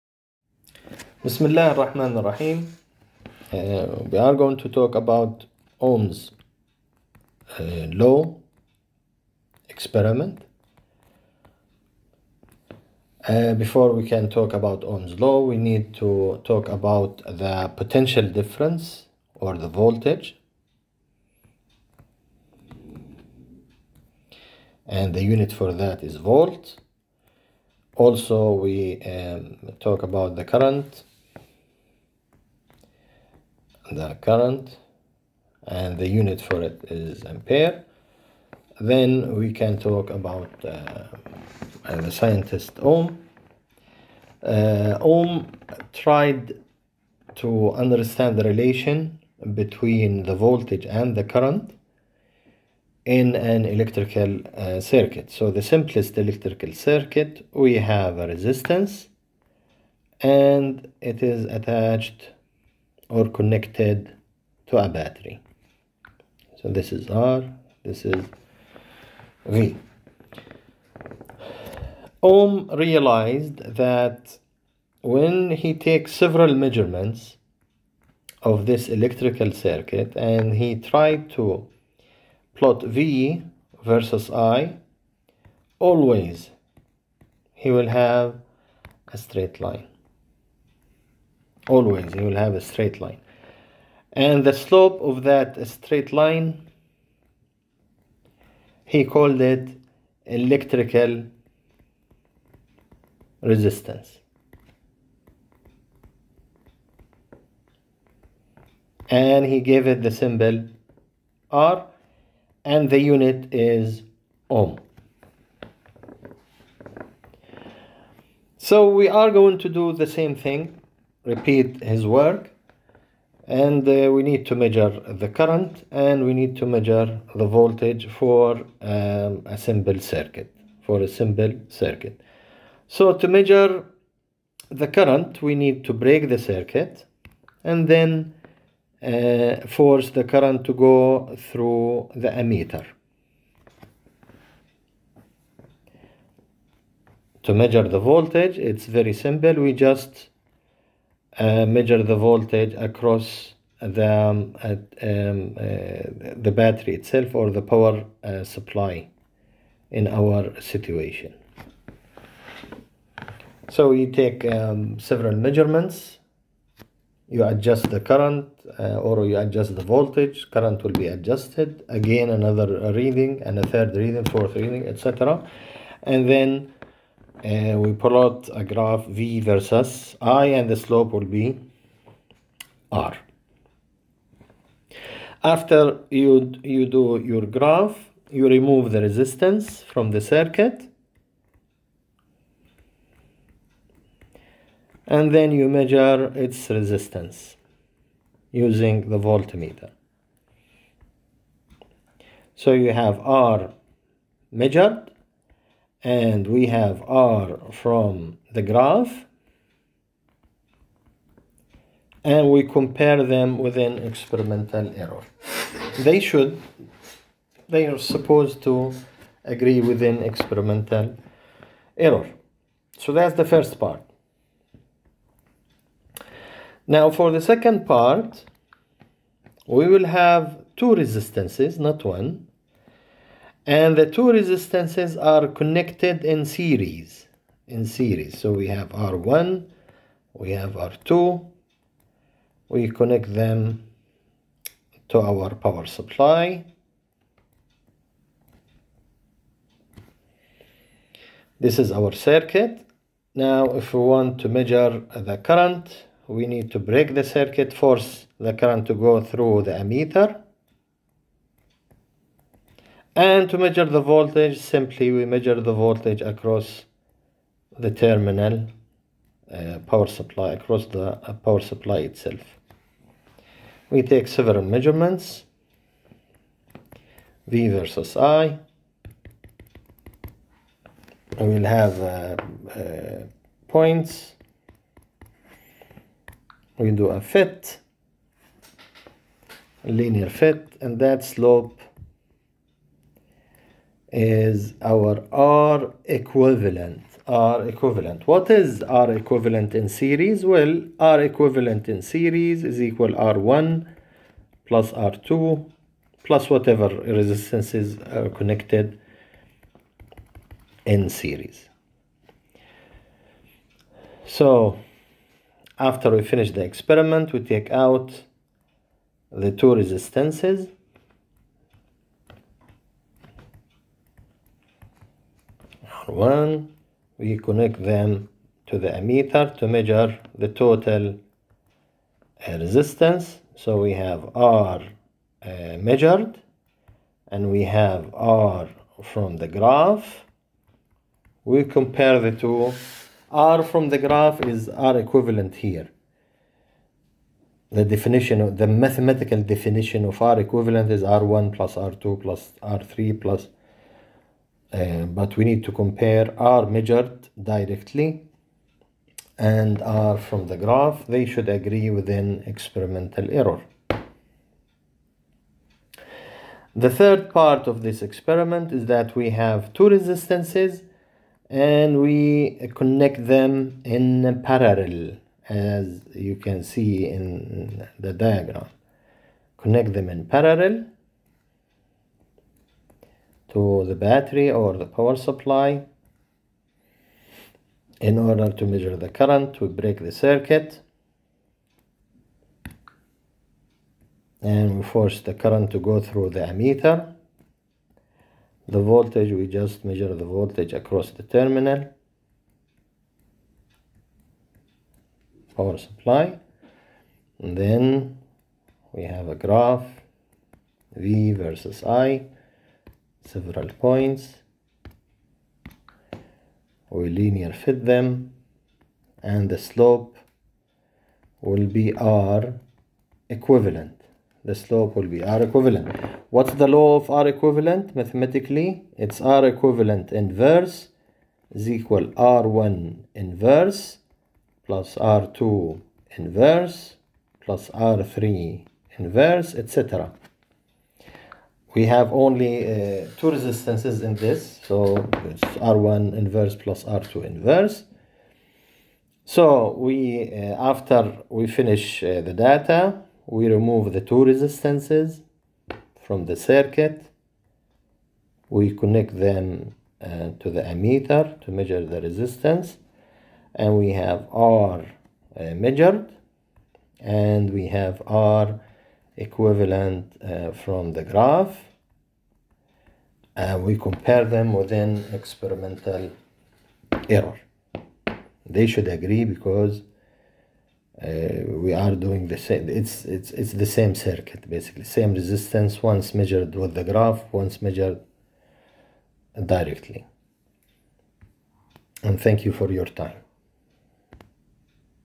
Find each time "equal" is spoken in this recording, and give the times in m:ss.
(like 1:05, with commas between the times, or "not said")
5:02, 7:11.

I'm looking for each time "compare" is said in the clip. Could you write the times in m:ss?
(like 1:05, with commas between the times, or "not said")
3:32, 5:41, 5:55, 7:53.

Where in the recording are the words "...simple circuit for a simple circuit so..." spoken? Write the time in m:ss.
2:09.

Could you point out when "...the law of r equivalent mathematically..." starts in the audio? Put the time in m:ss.
7:06.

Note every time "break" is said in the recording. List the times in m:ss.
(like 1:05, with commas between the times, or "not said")
2:15, 4:16, 6:29.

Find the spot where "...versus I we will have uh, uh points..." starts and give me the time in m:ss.
4:37.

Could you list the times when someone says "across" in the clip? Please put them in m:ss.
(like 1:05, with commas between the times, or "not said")
2:32, 4:26, 4:30, 6:40.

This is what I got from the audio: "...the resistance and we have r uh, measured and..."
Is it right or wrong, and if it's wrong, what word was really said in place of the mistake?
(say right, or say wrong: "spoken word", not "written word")
right.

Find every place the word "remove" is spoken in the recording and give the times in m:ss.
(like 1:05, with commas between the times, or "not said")
3:08, 7:33.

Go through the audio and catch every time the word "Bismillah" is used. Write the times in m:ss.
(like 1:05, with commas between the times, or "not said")
0:01.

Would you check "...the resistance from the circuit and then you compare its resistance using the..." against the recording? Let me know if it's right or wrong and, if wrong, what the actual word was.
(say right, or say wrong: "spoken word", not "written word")
wrong: "measure", not "compare".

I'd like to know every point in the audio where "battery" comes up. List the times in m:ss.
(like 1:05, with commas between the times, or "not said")
1:04, 2:36, 6:23.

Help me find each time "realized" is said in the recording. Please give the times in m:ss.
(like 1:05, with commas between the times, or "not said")
1:12.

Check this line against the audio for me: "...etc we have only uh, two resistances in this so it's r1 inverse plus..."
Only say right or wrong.
right.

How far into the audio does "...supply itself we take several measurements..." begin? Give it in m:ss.
4:31.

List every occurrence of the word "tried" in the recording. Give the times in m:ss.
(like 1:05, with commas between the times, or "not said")
0:45, 1:20.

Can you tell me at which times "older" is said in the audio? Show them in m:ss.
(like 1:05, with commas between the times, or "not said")
not said.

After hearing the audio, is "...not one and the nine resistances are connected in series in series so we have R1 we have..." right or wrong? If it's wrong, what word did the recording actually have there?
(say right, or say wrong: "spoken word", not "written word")
wrong: "two", not "nine".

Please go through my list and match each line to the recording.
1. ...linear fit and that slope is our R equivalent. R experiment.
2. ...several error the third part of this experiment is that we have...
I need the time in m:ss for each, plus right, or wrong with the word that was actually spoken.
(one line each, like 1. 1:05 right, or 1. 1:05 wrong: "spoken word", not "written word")
1. 4:49 wrong: "equivalent", not "experiment"
2. 6:02 wrong: "experimental", not "several".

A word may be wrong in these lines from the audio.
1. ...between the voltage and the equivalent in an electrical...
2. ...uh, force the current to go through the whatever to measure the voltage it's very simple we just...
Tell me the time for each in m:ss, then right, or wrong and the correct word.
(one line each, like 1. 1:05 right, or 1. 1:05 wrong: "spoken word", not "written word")
1. 0:49 wrong: "current", not "equivalent"
2. 2:19 wrong: "ammeter", not "whatever".